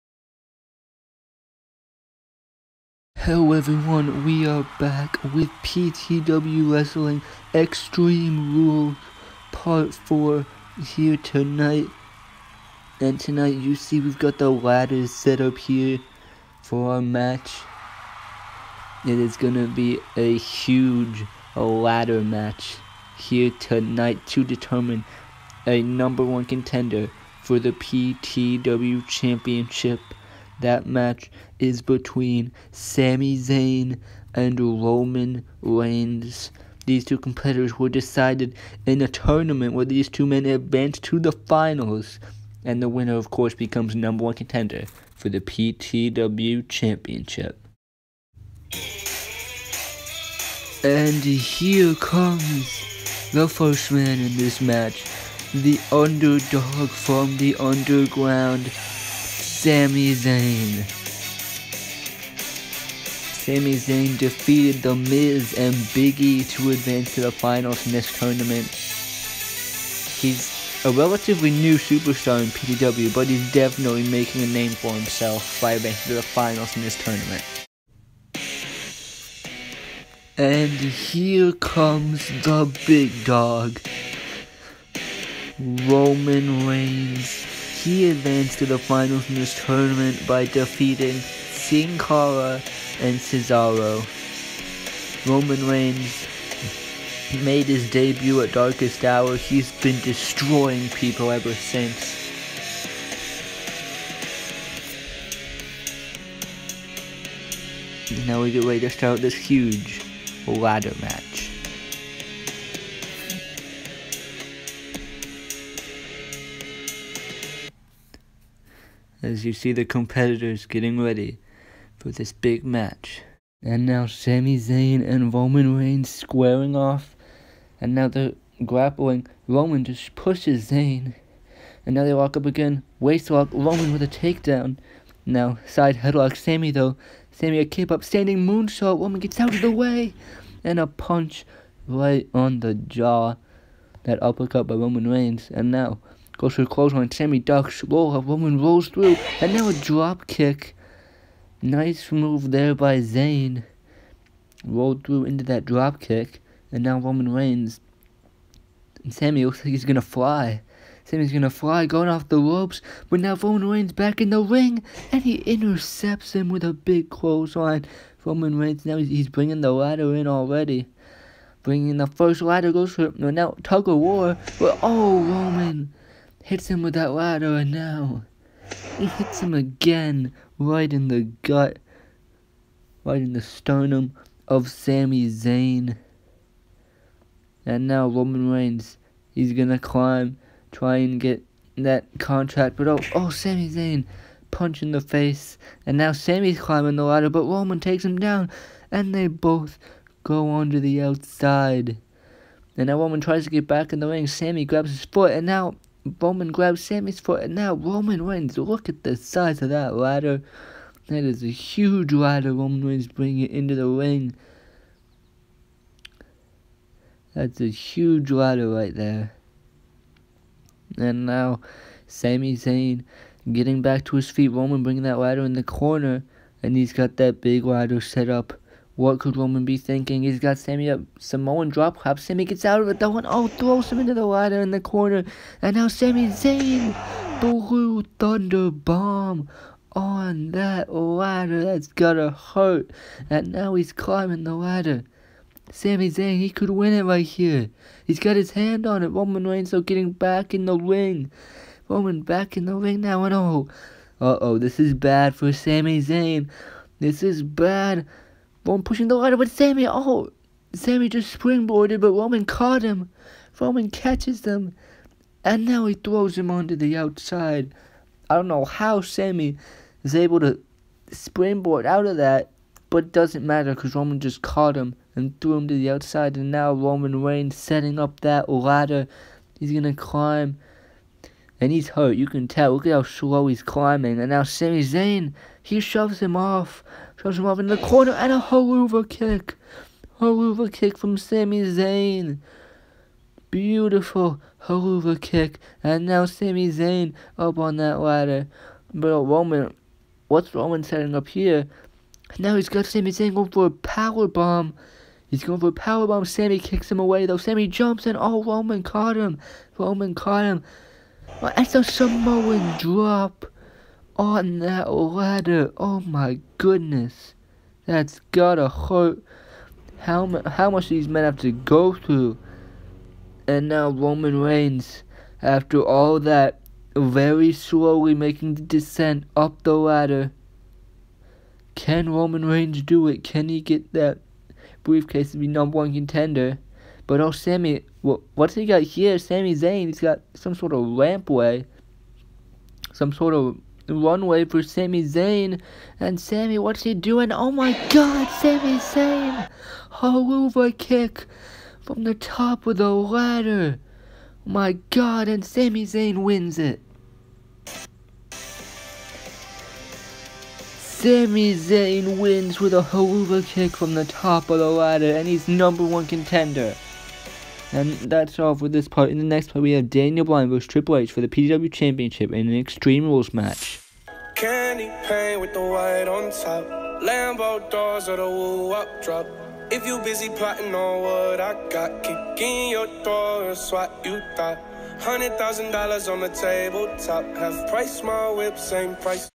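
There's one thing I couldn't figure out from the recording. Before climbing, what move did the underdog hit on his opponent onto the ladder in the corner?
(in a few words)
Blue Thunder Bomb.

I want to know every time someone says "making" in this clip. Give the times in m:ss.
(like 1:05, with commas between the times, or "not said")
1:14, 5:28.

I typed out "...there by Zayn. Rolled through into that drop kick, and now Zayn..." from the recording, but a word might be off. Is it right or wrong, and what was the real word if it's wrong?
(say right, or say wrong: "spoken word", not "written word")
wrong: "Roman", not "Zayn".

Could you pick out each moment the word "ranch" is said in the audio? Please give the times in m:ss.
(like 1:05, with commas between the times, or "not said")
not said.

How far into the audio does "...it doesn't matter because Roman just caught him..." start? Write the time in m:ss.
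4:33.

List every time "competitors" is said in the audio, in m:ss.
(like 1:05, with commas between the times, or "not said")
0:37, 1:59.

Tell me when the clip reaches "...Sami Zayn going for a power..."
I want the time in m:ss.
5:02.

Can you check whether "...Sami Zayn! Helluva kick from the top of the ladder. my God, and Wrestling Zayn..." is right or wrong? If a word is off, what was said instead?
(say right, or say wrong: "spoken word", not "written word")
wrong: "Sami", not "Wrestling".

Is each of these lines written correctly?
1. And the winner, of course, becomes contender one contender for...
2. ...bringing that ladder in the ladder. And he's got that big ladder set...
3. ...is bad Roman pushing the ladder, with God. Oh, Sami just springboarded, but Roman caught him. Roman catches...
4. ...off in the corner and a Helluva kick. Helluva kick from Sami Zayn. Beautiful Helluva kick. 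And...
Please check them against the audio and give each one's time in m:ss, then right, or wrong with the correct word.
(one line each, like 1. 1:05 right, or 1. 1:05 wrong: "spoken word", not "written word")
1. 0:42 wrong: "number", not "contender"
2. 3:44 wrong: "corner", not "ladder"
3. 4:17 wrong: "Sami", not "God"
4. 4:47 right.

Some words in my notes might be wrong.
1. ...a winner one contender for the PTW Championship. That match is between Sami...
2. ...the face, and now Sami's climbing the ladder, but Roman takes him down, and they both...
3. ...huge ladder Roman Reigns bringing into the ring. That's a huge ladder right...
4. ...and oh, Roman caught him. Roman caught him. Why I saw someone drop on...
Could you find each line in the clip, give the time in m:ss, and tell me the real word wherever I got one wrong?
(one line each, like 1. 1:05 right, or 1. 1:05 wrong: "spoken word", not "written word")
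1. 0:25 wrong: "number", not "winner"
2. 3:14 right
3. 3:31 right
4. 5:08 right.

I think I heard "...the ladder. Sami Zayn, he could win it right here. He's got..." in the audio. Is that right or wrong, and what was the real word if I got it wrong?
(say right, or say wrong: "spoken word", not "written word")
right.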